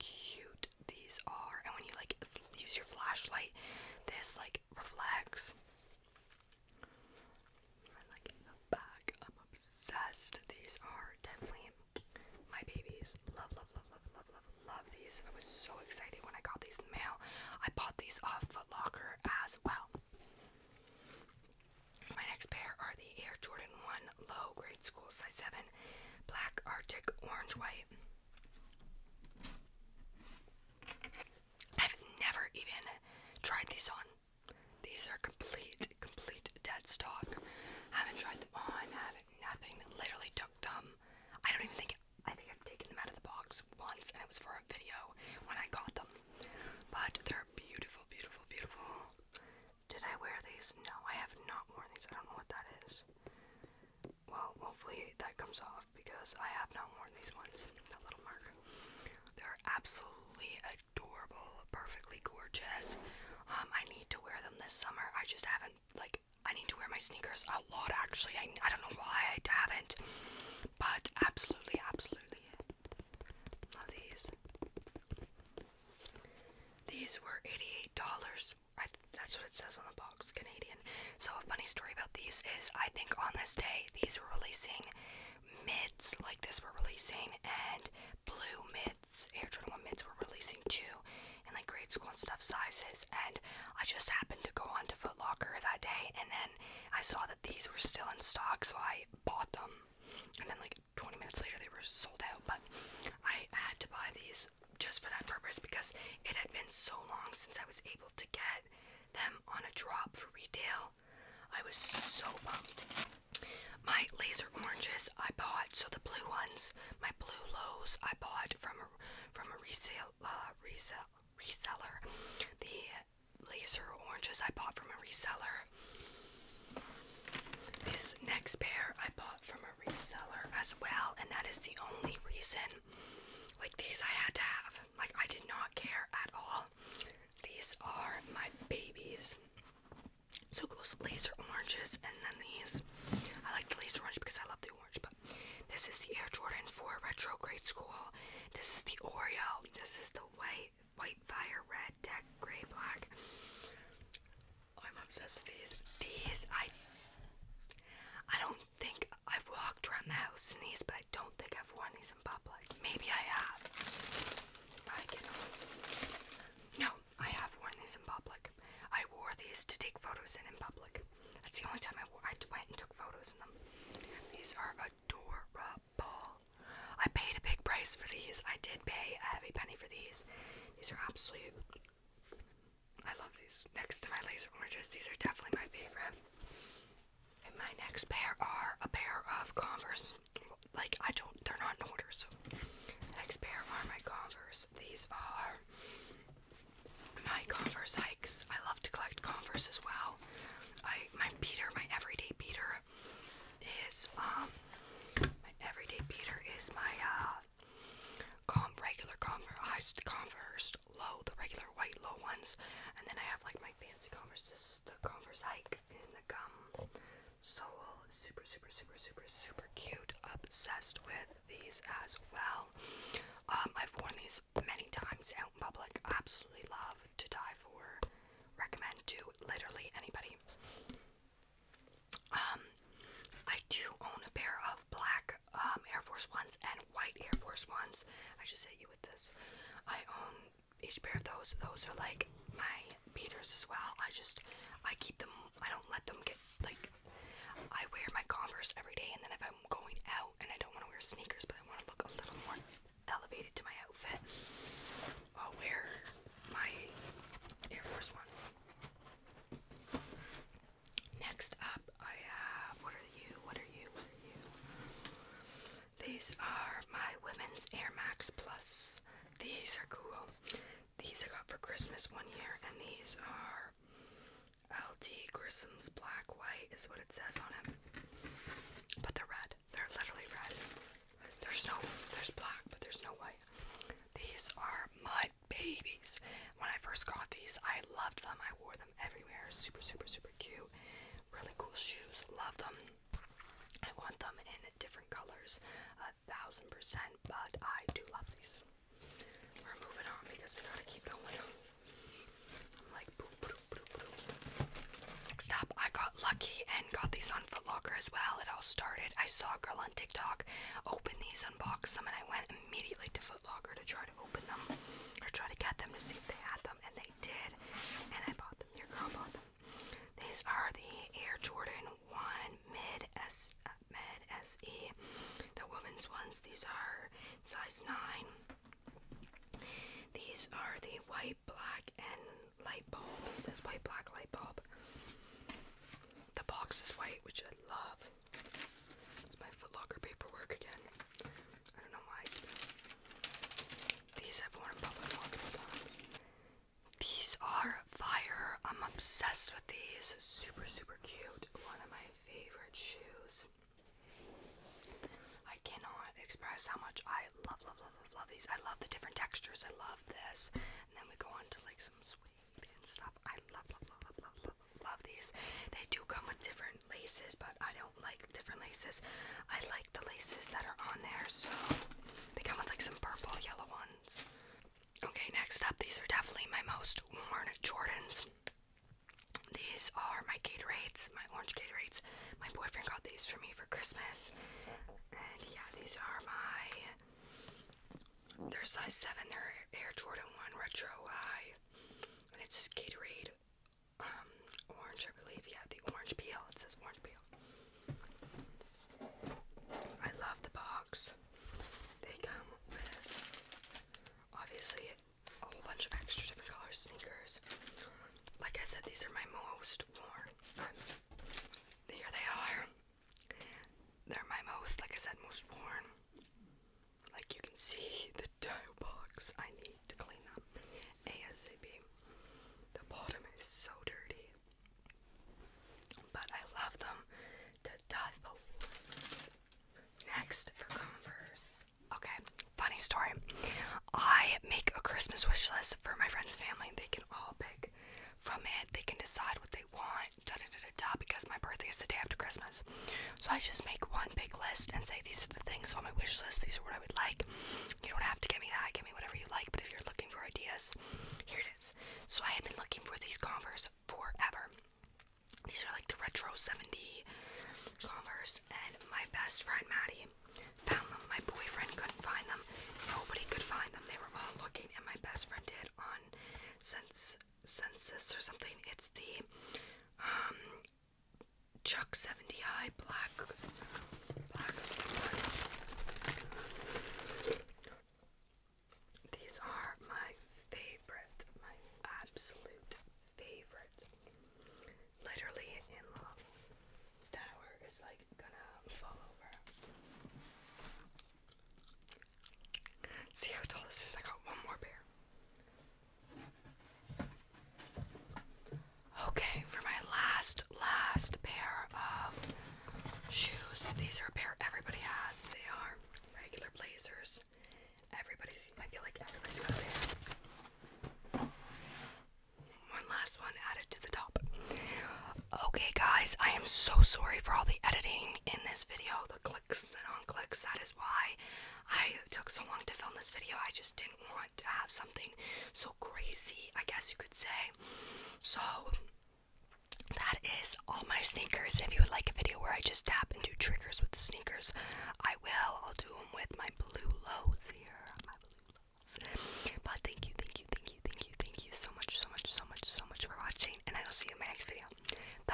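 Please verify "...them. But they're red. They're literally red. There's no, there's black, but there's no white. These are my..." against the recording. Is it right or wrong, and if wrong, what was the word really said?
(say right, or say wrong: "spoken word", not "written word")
right.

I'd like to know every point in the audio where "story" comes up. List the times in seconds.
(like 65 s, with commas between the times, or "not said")
81 s, 432 s.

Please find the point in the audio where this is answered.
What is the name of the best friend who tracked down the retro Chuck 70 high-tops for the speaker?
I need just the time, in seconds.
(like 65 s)
459 s.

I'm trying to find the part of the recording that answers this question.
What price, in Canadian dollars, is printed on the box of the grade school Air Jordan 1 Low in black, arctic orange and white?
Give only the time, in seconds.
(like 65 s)
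77 s.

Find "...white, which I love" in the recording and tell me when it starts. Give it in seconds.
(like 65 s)
336 s.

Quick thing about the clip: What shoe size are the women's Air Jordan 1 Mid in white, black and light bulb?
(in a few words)
9.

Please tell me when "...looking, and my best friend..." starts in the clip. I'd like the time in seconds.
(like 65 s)
464 s.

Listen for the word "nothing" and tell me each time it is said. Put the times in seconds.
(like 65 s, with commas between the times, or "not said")
39 s.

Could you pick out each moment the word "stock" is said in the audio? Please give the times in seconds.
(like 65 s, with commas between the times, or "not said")
36 s, 98 s.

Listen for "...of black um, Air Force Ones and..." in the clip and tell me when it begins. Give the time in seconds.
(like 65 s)
234 s.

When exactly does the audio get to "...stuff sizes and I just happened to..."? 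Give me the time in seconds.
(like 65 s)
92 s.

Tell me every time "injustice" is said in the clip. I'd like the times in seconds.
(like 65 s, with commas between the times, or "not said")
not said.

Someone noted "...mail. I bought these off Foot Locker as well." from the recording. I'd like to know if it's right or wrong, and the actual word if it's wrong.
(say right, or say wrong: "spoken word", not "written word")
right.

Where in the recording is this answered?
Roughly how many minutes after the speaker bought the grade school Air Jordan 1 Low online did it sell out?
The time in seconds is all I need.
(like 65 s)
100 s.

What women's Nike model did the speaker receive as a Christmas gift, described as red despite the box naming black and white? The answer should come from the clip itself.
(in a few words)
Air Max Plus.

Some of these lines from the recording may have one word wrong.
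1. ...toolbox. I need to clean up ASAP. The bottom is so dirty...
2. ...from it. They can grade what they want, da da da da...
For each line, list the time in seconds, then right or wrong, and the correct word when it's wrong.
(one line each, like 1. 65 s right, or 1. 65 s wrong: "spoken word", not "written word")
1. 418 s right
2. 438 s wrong: "decide", not "grade".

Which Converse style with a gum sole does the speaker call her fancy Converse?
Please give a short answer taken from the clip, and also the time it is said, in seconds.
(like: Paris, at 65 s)
Converse hike, at 215 s.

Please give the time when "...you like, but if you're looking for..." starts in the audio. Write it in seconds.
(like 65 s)
449 s.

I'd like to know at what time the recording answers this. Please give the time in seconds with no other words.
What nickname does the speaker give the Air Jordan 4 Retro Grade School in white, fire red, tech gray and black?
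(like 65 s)
149 s.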